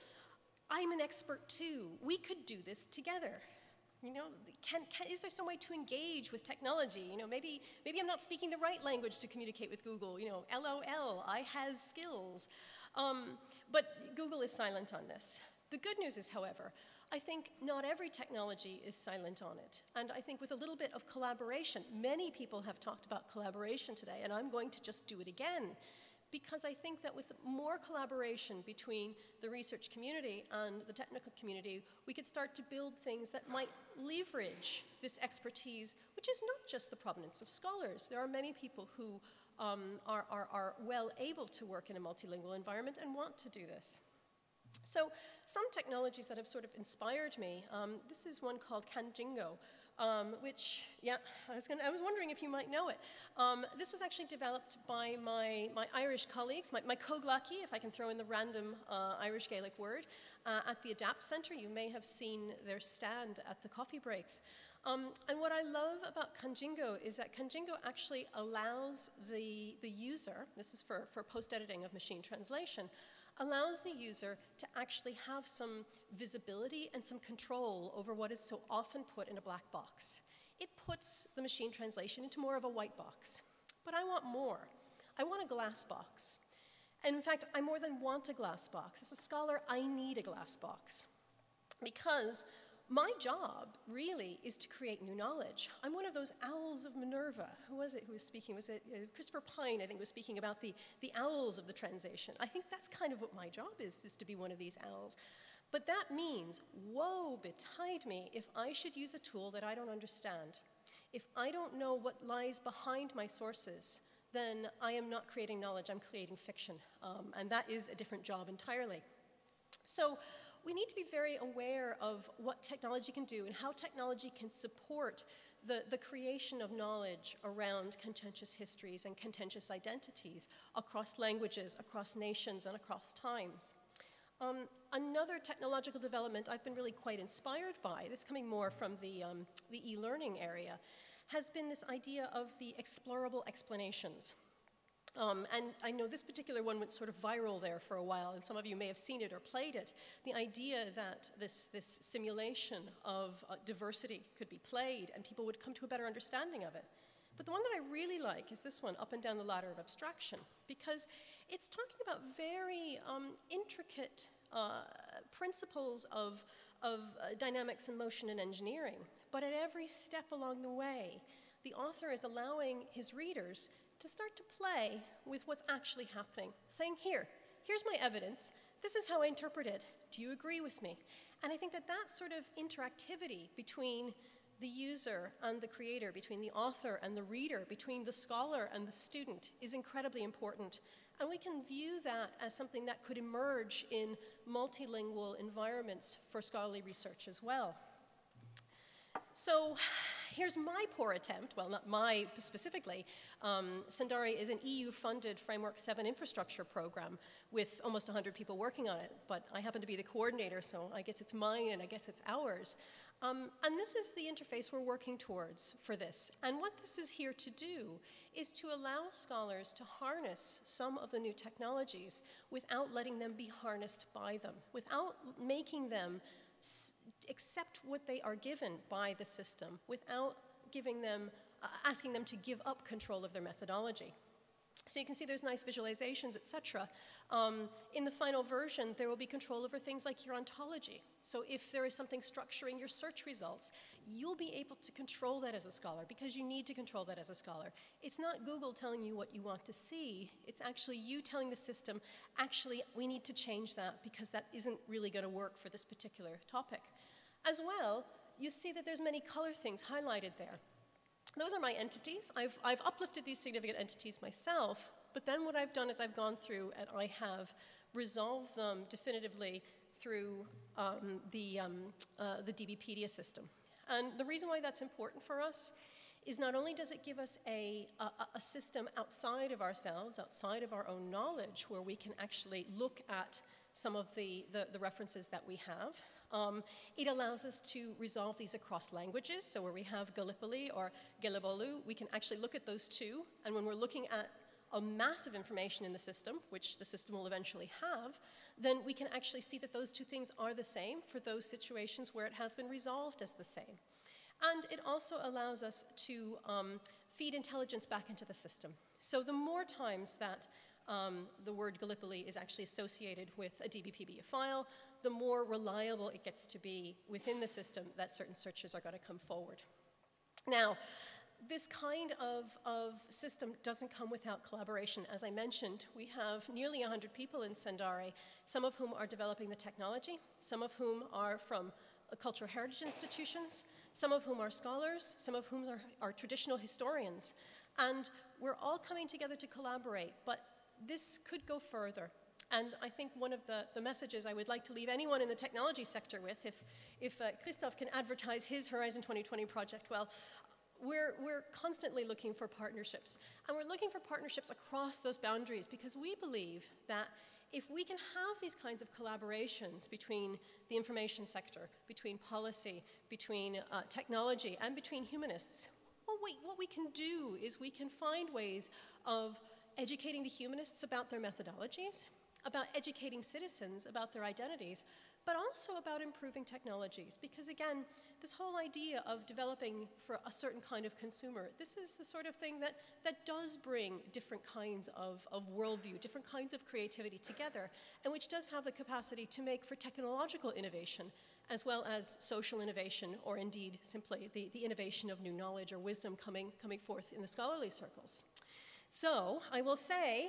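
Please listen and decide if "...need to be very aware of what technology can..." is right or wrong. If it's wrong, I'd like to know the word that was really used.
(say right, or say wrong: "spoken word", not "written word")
right.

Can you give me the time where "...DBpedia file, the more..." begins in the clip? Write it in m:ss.
5:13.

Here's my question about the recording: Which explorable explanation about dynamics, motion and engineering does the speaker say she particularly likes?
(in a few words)
Up and Down the Ladder of Abstraction.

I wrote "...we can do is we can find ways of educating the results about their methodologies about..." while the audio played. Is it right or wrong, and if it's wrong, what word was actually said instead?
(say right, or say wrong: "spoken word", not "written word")
wrong: "humanists", not "results".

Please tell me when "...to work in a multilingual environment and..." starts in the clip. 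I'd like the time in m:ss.
0:41.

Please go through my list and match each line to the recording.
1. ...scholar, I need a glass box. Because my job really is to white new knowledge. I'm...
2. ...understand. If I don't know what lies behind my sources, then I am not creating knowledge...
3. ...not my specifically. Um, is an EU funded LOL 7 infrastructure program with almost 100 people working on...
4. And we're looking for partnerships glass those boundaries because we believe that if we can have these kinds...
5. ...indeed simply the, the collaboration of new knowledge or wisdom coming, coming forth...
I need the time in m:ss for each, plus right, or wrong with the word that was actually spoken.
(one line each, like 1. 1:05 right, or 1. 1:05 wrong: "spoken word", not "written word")
1. 1:29 wrong: "create", not "white"
2. 1:49 right
3. 3:21 wrong: "Framework", not "LOL"
4. 5:53 wrong: "across", not "glass"
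5. 6:33 wrong: "innovation", not "collaboration".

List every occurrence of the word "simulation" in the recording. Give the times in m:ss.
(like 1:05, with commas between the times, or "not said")
2:32.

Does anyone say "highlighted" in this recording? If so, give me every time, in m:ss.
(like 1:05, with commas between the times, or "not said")
4:19.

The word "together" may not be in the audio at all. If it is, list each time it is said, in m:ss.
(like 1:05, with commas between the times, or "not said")
0:02, 5:39, 6:27.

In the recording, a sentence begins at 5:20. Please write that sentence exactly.
Now, this kind of, of system doesn't come without collaboration.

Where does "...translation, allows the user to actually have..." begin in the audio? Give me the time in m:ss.
1:12.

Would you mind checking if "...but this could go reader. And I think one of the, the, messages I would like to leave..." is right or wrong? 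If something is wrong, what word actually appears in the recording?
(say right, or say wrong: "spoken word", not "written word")
wrong: "further", not "reader".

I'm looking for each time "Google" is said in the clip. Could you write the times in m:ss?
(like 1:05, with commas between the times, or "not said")
0:09, 0:14, 4:08.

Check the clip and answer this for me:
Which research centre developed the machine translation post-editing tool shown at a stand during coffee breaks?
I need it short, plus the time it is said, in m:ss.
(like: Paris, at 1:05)
ADAPT Centre, at 1:00.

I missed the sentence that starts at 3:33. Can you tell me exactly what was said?
Um, and this is the interface we're working towards for this.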